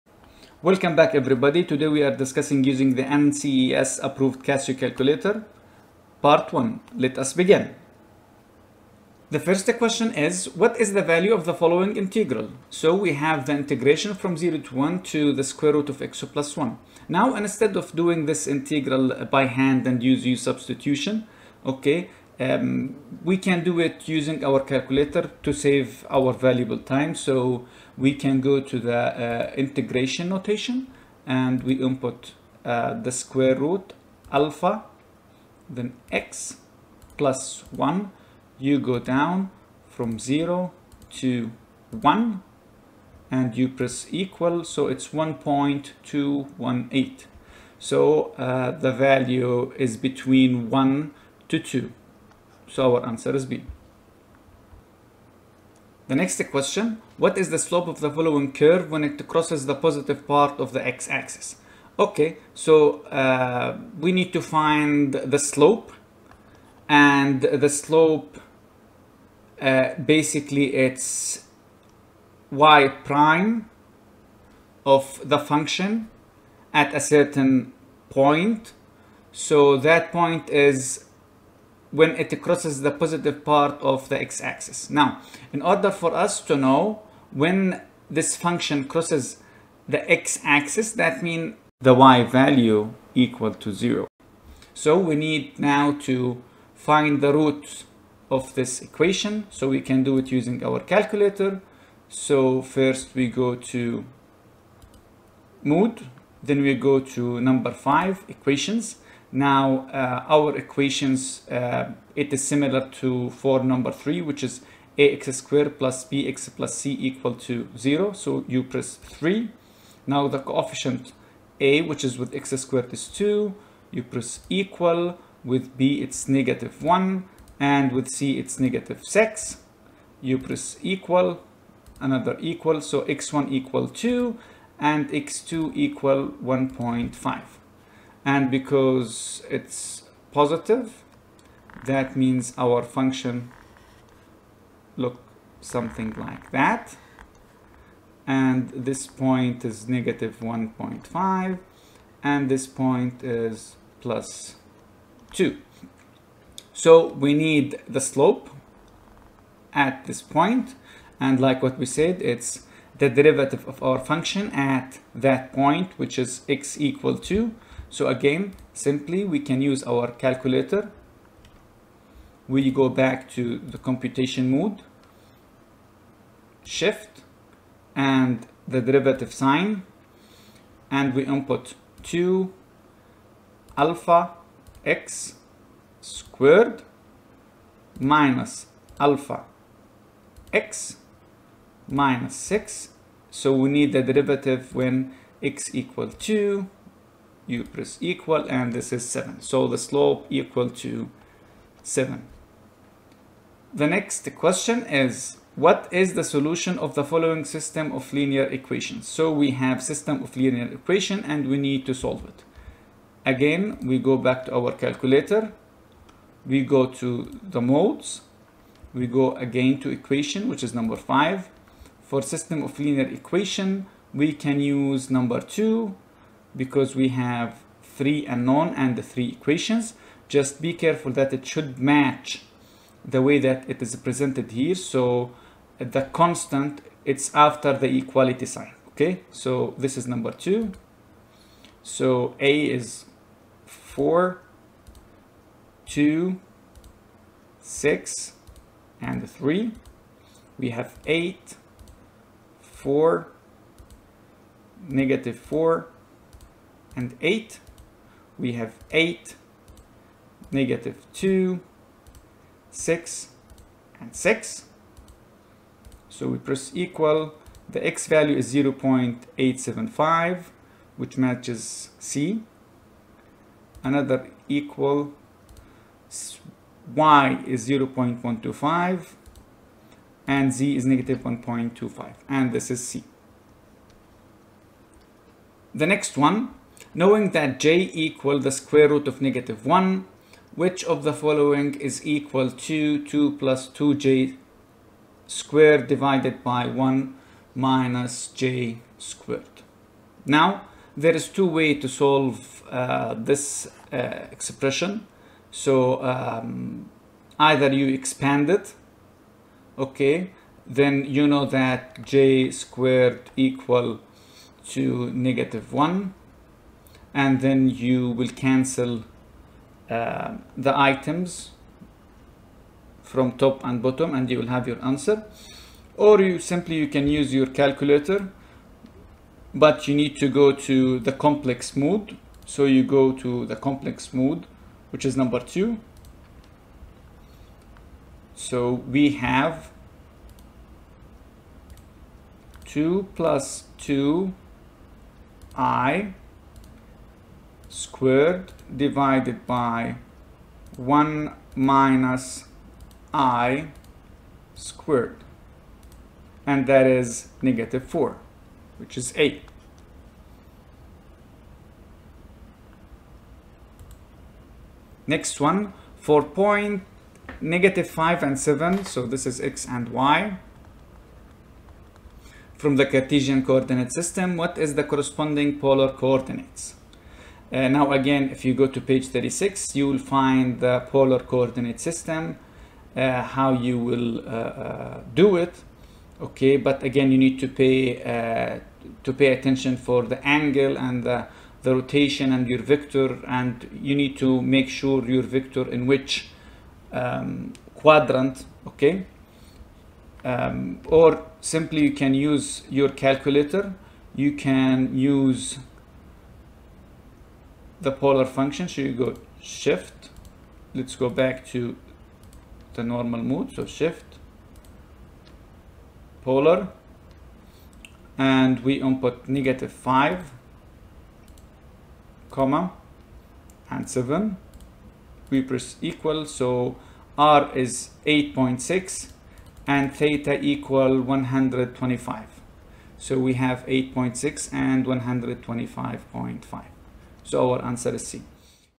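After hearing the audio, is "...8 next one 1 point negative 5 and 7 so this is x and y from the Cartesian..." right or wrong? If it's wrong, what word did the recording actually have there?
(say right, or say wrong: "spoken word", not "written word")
wrong: "4", not "1".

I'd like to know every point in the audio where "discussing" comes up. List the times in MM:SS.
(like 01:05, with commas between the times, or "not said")
00:02.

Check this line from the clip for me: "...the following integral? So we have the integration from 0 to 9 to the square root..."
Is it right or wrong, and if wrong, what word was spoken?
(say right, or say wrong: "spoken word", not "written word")
wrong: "1", not "9".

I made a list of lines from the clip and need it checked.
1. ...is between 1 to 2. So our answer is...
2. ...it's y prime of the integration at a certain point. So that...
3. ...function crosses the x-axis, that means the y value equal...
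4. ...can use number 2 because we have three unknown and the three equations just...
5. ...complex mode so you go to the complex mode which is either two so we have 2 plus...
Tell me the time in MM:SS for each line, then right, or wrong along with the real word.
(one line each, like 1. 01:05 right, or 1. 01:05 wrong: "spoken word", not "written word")
1. 00:49 right
2. 01:10 wrong: "function", not "integration"
3. 01:28 right
4. 03:44 right
5. 05:31 wrong: "number", not "either".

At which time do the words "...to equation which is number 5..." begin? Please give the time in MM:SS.
03:39.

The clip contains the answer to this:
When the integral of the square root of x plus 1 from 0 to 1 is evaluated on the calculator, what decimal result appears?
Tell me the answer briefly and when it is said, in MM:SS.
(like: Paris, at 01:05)
1.218, at 00:45.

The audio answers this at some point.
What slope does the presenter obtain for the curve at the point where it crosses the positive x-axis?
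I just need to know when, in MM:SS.
03:19.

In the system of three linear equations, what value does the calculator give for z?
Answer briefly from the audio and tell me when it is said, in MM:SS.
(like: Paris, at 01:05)
-1.25, at 04:40.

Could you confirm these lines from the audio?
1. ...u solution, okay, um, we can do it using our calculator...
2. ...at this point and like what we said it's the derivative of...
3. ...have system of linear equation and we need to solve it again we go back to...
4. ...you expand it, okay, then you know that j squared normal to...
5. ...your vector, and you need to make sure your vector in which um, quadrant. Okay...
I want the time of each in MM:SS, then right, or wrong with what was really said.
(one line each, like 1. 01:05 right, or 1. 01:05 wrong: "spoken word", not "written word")
1. 00:20 wrong: "substitution", not "solution"
2. 02:39 right
3. 03:29 right
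4. 05:07 wrong: "equal", not "normal"
5. 06:32 right.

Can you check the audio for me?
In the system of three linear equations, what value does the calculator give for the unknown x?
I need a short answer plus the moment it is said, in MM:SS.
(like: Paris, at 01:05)
0.875, at 04:28.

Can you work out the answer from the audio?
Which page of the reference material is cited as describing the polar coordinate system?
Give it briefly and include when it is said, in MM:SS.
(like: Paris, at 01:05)
36, at 06:18.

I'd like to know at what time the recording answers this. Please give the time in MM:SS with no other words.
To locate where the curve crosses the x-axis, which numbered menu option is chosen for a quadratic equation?
01:58.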